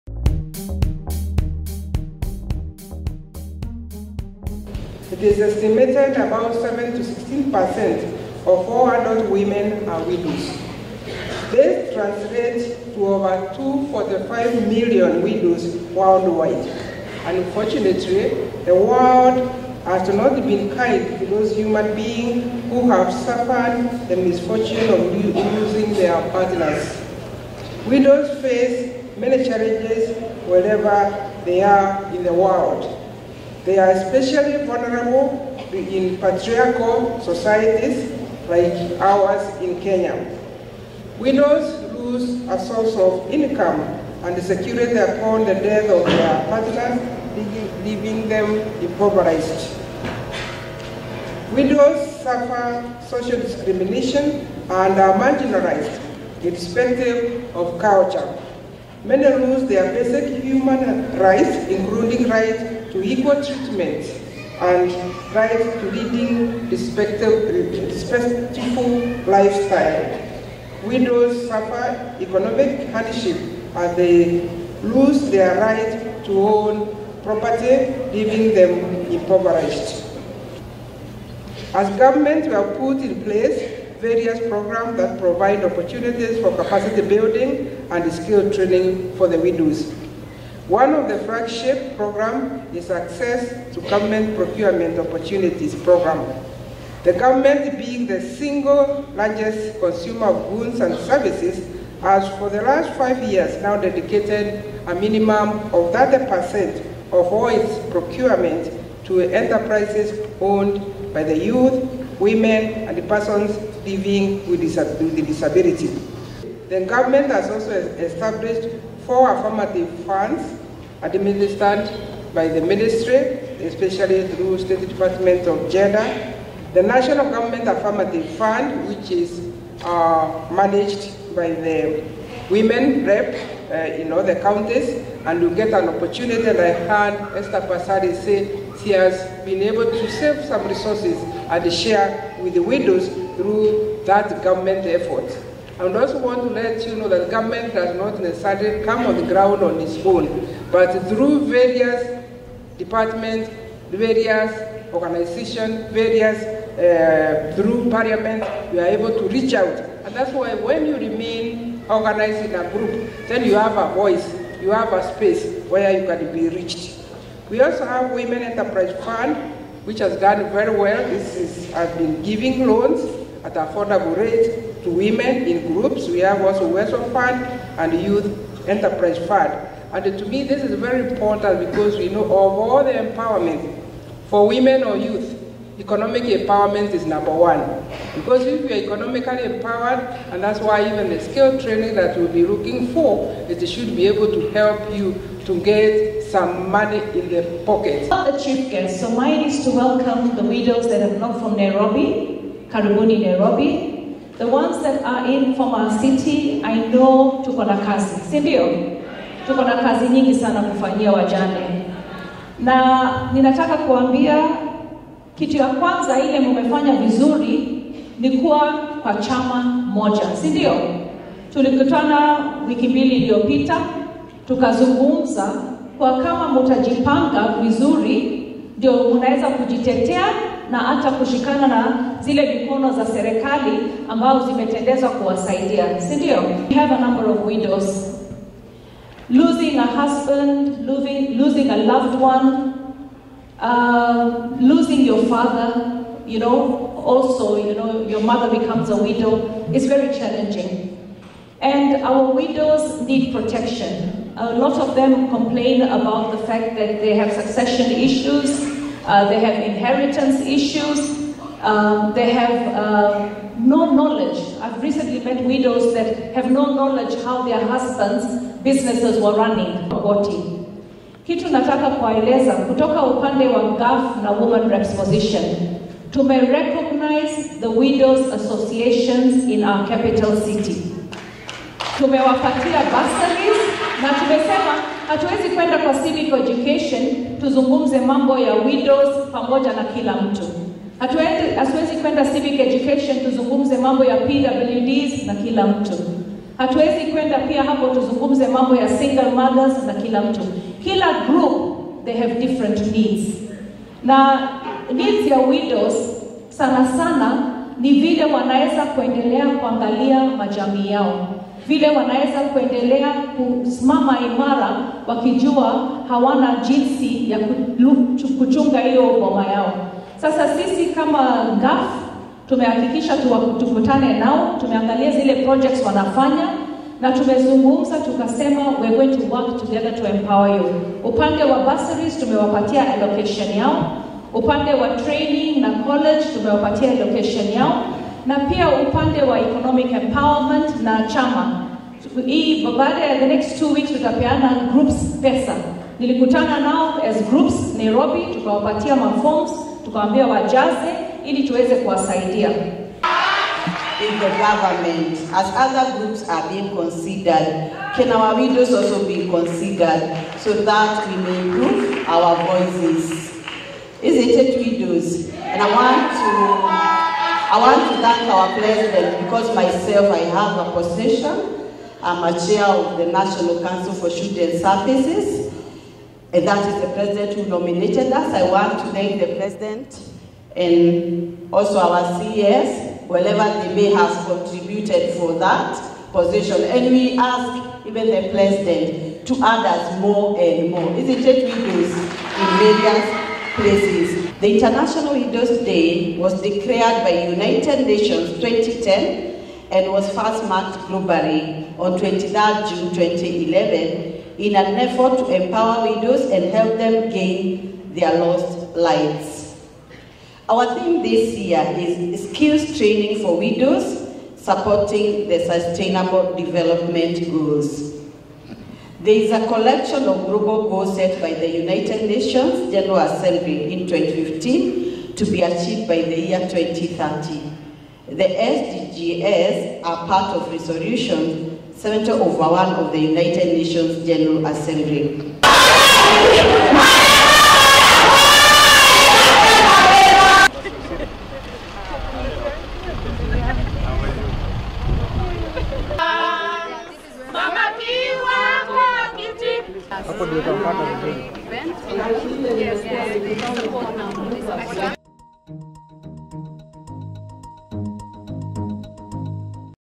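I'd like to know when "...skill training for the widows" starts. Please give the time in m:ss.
1:28.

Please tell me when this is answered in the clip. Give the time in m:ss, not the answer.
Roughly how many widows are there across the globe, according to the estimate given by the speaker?
0:13.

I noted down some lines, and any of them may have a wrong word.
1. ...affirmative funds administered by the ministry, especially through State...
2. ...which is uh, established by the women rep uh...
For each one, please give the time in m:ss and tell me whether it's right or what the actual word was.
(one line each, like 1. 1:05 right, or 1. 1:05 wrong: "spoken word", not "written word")
1. 1:59 right
2. 2:08 wrong: "managed", not "established".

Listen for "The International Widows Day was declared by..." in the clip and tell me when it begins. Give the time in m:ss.
6:34.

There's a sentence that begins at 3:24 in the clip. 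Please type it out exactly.
The ones that are in from our city, I know tuko na kazi, si ndio?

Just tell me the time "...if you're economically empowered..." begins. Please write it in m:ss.
3:08.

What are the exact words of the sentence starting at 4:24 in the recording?
I've recently met widows that have no knowledge how their husbands' businesses were running.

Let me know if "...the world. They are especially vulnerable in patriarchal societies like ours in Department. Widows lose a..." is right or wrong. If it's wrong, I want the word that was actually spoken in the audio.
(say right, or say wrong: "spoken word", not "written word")
wrong: "Kenya", not "Department".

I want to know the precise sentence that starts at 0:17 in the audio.
Unfortunately, the world has not been kind to those human beings who have suffered the misfortune of losing their partners.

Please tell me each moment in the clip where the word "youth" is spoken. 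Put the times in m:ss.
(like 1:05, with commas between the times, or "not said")
1:51, 2:58, 3:04.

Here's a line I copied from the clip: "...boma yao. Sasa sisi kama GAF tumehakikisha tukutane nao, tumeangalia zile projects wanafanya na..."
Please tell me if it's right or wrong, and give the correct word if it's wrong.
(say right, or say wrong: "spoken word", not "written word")
right.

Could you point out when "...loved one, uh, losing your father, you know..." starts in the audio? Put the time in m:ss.
4:01.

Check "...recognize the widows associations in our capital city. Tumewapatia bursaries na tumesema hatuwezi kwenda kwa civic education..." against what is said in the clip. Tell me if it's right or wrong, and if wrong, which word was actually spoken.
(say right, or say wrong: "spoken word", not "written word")
right.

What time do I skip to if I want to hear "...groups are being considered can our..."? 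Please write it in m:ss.
5:55.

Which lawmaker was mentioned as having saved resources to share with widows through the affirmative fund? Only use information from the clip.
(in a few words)
Esther Passaris.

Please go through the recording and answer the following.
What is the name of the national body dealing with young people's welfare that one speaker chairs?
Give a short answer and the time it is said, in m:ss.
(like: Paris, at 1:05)
National Council for Children Services, at 6:13.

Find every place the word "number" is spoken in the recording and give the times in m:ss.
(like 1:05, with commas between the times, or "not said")
3:07, 3:56.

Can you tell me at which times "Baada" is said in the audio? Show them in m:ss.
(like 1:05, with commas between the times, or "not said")
5:42.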